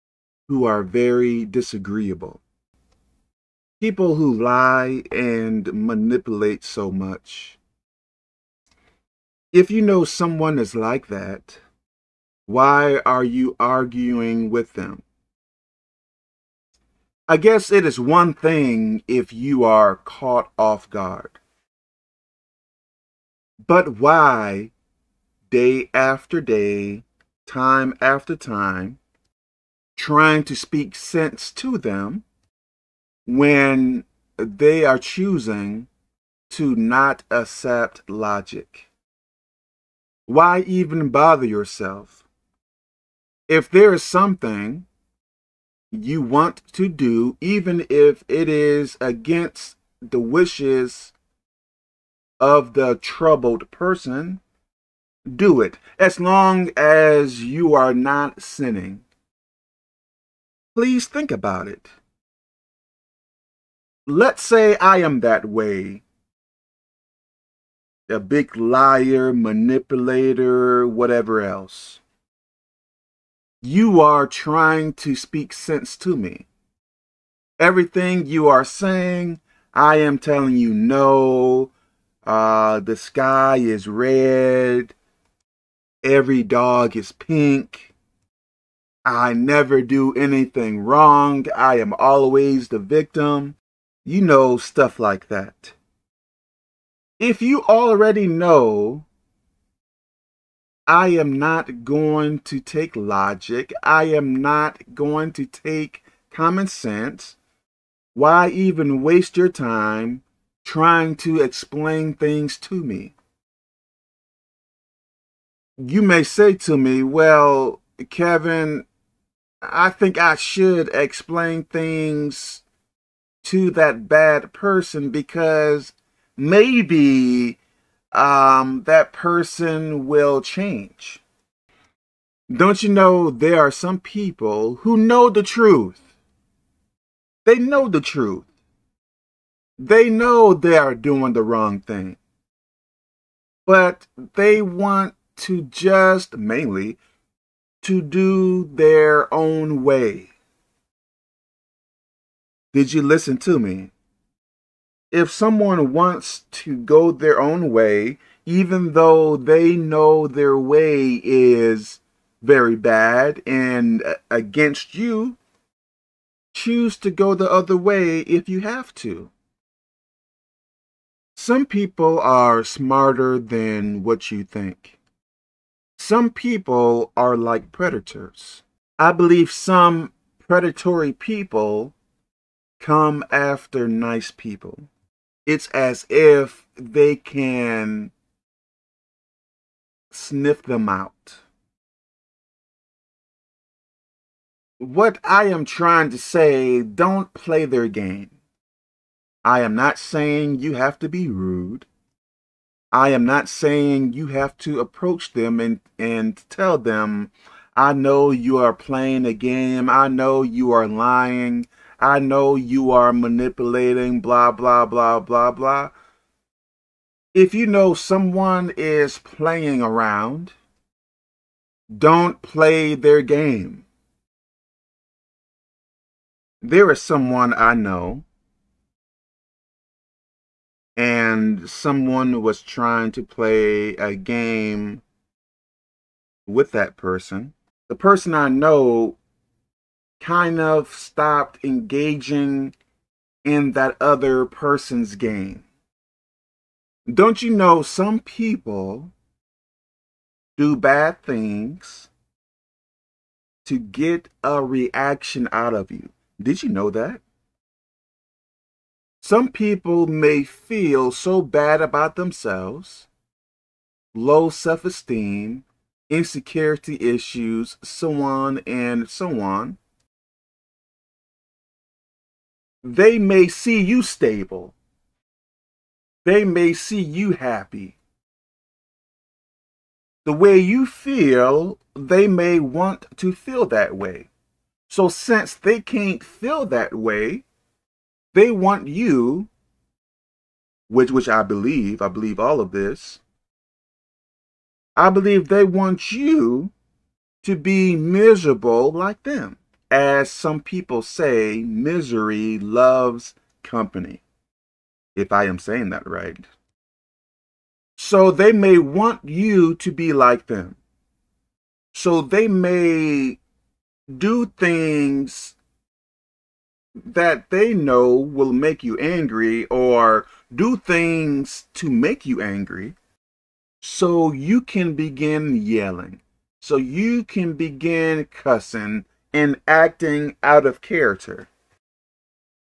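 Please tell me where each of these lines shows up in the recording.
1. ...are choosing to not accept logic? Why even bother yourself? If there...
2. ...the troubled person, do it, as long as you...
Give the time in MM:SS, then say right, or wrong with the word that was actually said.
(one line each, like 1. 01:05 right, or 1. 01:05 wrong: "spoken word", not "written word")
1. 00:34 right
2. 00:52 right.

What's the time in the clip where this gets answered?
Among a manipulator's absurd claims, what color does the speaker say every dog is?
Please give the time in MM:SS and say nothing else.
01:27.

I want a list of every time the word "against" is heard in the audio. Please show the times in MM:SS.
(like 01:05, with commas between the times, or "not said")
00:49, 02:44.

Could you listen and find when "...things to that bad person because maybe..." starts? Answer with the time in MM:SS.
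02:01.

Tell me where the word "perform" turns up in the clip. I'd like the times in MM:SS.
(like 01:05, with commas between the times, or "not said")
not said.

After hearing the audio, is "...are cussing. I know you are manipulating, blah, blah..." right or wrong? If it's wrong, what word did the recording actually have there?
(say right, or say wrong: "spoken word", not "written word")
wrong: "lying", not "cussing".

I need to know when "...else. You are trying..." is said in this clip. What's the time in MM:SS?
01:11.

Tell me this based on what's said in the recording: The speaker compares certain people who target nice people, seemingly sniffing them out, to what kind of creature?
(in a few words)
predators.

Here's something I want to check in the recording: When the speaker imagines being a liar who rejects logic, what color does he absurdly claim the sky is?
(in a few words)
red.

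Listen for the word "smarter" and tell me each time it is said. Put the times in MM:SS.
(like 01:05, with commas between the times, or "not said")
02:52.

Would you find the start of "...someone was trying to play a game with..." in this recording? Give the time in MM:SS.
03:51.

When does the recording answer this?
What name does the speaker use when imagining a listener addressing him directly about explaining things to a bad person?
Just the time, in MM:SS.
01:58.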